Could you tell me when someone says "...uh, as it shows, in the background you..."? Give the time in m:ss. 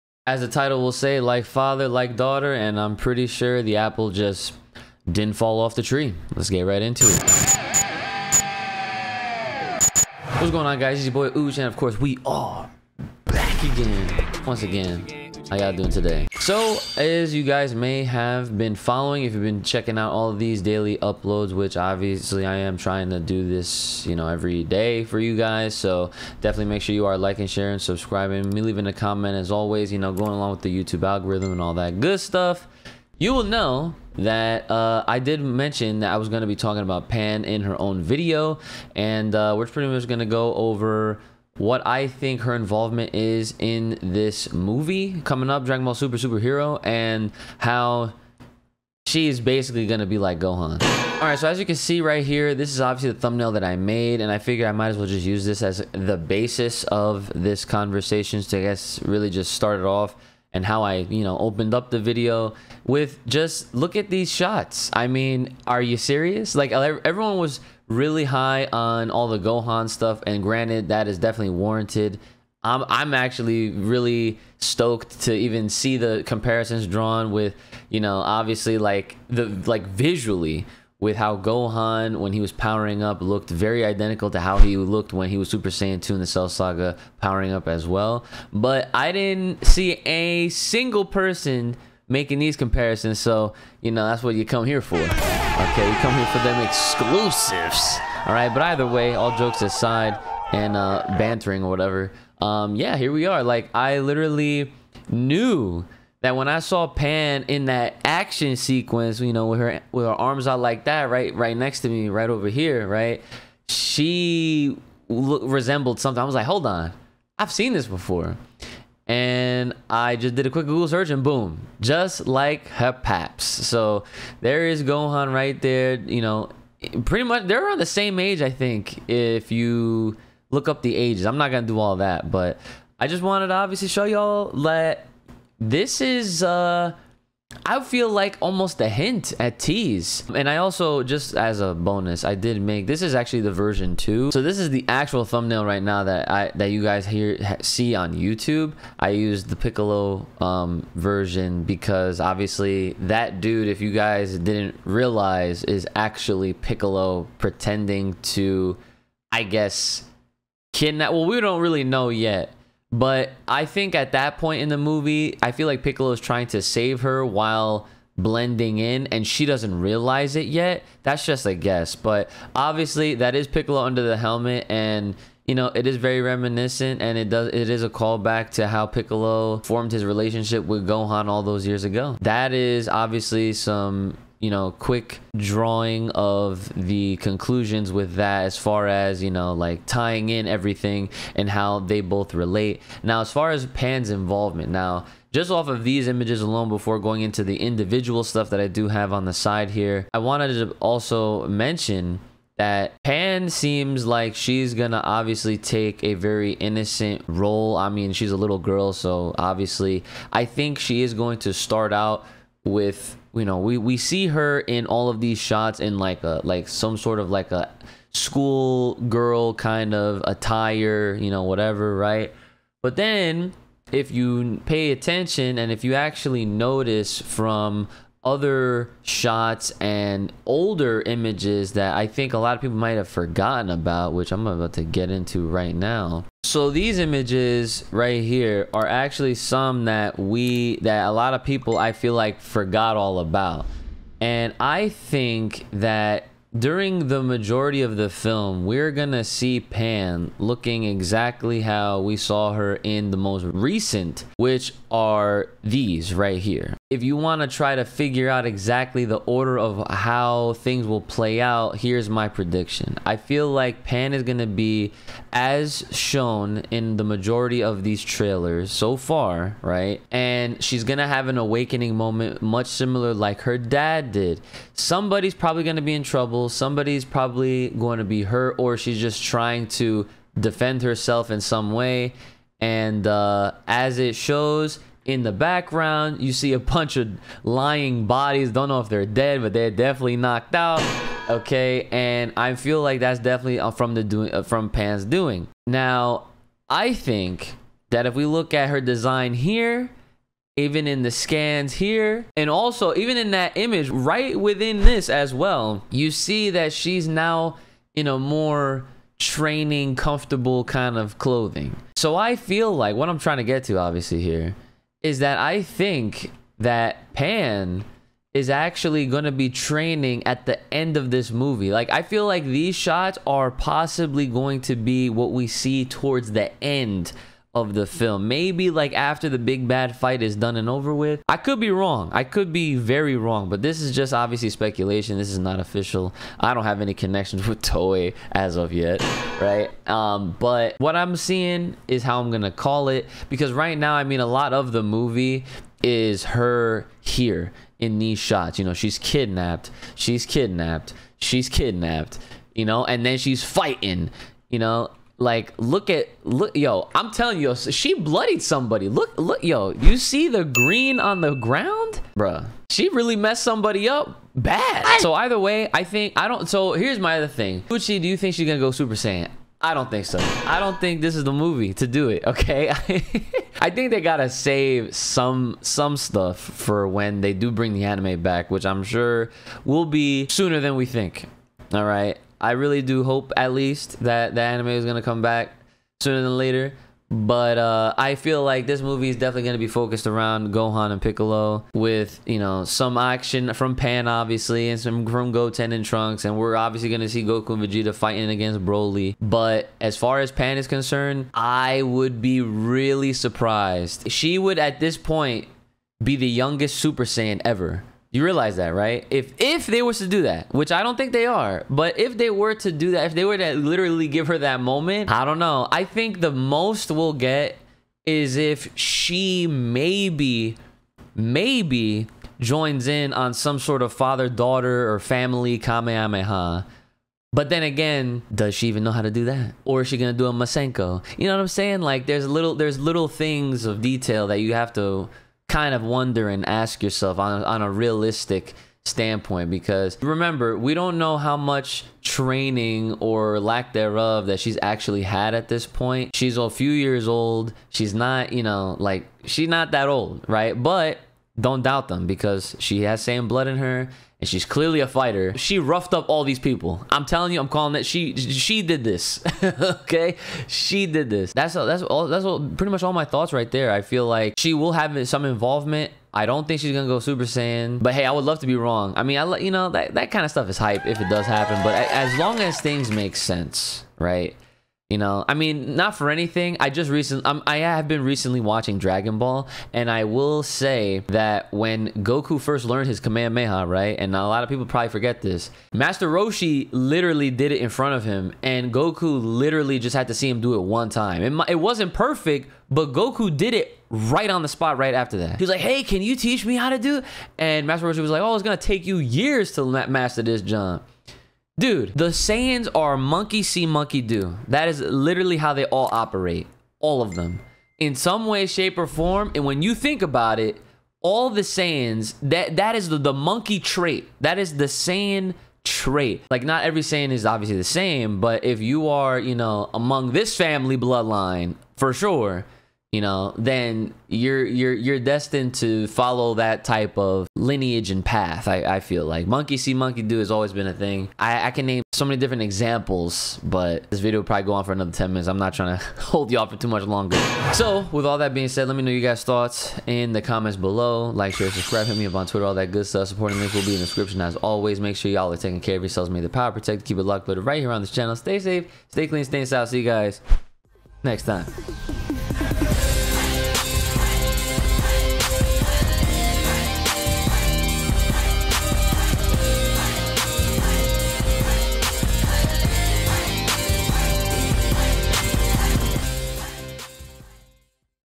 4:43.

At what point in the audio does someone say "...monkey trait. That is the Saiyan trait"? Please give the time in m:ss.
8:33.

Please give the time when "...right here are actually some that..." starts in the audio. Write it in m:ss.
3:57.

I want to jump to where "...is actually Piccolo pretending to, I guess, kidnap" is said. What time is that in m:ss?
2:35.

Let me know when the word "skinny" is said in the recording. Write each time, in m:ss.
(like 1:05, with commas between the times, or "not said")
not said.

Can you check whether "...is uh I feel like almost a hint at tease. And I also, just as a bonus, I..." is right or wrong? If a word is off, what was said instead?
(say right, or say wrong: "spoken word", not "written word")
right.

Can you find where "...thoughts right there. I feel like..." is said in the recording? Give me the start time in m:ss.
7:43.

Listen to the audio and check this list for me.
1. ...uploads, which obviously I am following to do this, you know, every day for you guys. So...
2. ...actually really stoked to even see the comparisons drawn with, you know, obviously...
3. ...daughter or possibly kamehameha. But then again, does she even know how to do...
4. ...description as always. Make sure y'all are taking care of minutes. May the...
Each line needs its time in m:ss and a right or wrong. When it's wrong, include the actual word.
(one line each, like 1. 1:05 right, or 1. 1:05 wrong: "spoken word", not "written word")
1. 0:20 wrong: "trying", not "following"
2. 1:13 right
3. 7:04 wrong: "family", not "possibly"
4. 9:03 wrong: "yourselves", not "minutes".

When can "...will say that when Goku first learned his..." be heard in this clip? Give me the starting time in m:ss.
8:00.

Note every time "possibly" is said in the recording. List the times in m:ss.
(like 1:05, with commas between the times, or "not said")
5:23.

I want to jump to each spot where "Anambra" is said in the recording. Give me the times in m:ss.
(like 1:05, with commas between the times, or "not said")
not said.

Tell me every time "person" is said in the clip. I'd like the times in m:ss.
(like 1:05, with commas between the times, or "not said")
1:31.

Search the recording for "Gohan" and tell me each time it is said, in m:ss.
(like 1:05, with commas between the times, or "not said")
0:50, 1:09, 1:21, 2:04, 3:00, 6:30.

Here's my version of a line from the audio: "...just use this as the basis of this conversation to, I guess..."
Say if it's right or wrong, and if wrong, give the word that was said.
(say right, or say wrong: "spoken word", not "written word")
right.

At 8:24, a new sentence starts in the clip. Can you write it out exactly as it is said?
That is literally how they all operate.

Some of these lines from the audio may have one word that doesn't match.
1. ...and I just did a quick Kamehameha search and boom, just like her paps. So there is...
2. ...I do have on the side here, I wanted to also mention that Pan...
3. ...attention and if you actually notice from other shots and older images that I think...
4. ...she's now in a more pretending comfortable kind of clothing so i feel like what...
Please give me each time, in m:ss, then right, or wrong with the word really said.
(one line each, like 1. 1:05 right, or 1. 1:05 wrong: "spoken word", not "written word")
1. 1:59 wrong: "Google", not "Kamehameha"
2. 3:18 right
3. 3:44 right
4. 5:06 wrong: "training", not "pretending".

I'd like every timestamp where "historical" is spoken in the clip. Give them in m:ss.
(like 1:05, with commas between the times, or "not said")
not said.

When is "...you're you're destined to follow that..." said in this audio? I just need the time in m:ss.
8:44.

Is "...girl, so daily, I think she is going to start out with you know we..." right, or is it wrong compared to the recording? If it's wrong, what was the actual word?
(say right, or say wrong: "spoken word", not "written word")
wrong: "obviously", not "daily".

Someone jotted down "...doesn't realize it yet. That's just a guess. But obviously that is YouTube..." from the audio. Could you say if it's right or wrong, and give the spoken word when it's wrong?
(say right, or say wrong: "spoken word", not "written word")
wrong: "Piccolo", not "YouTube".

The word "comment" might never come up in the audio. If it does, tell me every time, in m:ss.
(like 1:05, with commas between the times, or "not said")
0:28, 9:00.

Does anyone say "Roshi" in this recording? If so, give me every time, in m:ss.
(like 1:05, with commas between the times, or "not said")
8:06, 8:17.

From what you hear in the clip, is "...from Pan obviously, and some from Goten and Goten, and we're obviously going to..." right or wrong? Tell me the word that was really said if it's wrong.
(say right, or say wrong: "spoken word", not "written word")
wrong: "Trunks", not "Goten".